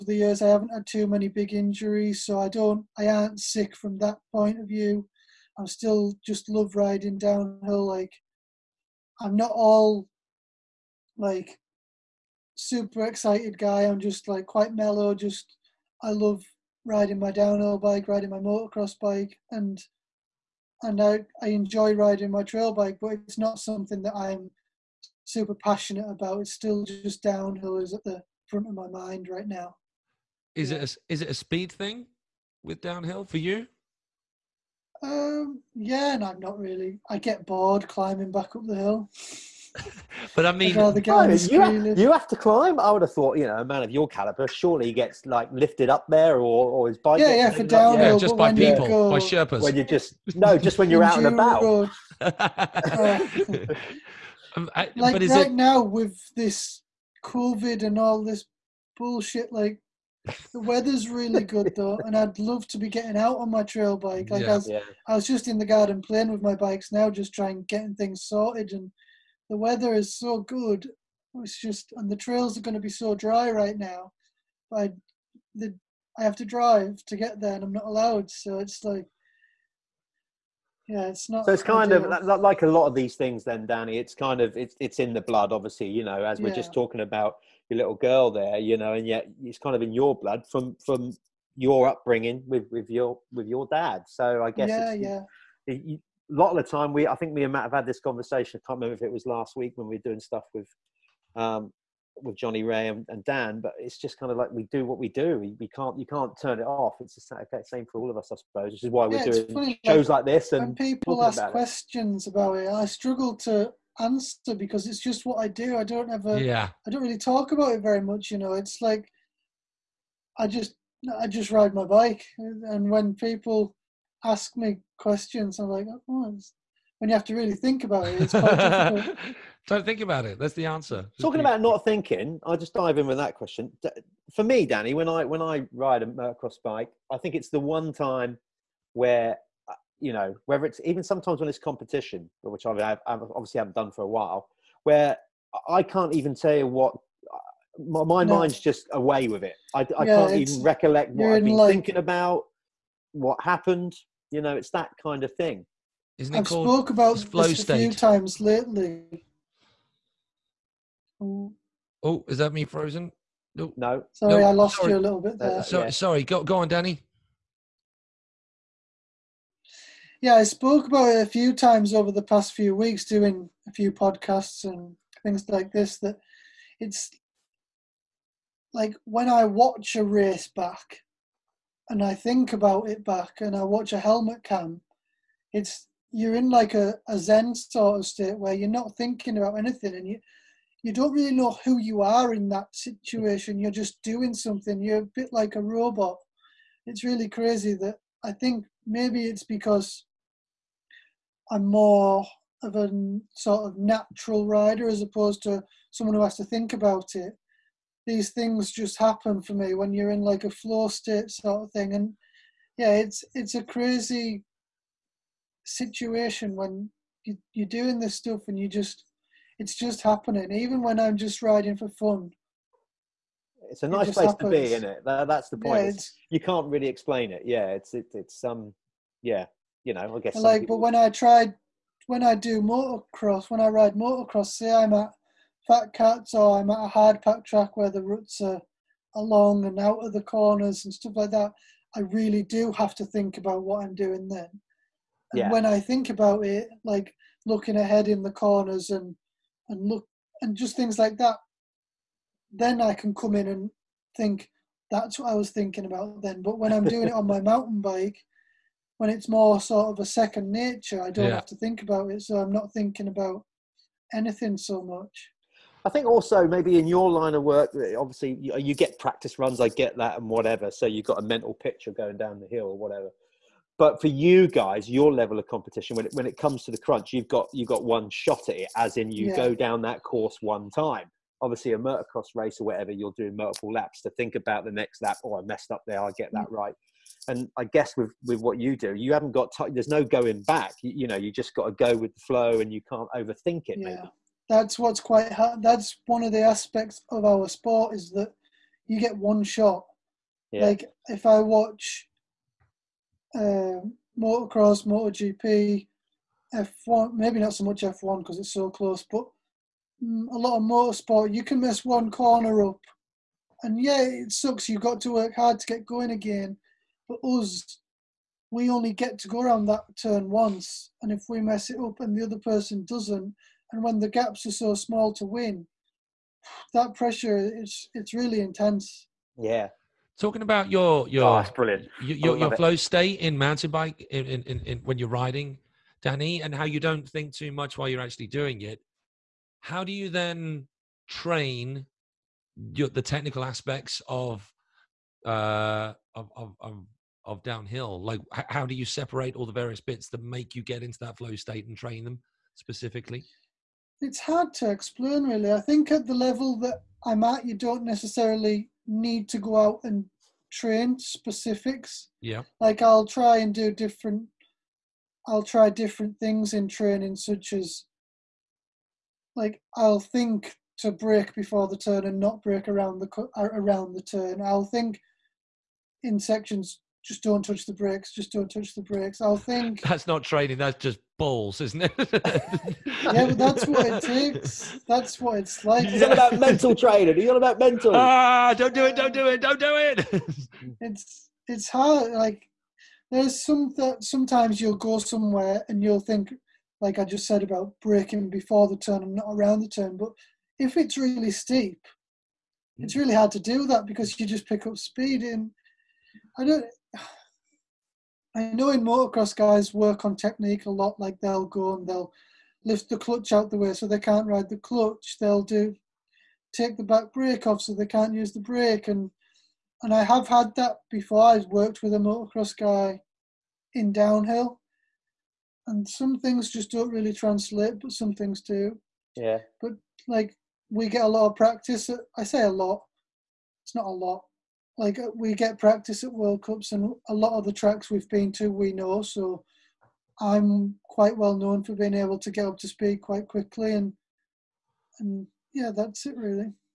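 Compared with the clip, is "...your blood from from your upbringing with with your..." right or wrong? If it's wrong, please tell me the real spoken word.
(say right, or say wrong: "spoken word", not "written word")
right.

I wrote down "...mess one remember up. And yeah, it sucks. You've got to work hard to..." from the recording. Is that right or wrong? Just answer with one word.
wrong.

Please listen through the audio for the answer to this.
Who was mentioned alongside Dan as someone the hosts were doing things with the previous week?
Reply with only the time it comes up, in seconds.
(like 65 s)
102 s.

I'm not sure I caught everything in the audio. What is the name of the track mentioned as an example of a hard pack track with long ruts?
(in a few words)
Fat Cats.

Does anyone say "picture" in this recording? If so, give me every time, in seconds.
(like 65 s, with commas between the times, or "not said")
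271 s.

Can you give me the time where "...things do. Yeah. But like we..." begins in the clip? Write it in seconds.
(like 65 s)
428 s.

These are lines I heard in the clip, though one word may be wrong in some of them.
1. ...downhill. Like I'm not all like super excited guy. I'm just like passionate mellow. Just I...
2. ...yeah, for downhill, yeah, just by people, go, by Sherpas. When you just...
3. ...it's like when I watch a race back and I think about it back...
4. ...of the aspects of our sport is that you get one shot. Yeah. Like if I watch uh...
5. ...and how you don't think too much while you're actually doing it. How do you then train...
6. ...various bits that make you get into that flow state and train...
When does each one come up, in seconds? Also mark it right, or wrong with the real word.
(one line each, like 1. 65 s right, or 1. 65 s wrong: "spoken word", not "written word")
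1. 7 s wrong: "quite", not "passionate"
2. 47 s right
3. 176 s right
4. 296 s right
5. 336 s right
6. 349 s right.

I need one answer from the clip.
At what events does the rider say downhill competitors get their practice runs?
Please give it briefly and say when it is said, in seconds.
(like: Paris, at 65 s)
World Cups, at 436 s.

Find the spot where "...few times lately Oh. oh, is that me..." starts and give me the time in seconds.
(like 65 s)
157 s.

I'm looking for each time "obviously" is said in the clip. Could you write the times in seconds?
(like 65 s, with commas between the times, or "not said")
85 s, 143 s, 267 s, 281 s.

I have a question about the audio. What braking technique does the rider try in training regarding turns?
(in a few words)
Brake before the turn.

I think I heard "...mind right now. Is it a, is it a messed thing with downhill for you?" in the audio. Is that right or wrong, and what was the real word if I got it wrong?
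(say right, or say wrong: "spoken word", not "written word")
wrong: "speed", not "messed".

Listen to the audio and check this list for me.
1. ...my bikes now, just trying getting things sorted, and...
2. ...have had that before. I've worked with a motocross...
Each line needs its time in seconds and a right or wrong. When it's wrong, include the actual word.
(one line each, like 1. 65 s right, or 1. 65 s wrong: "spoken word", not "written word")
1. 66 s right
2. 420 s right.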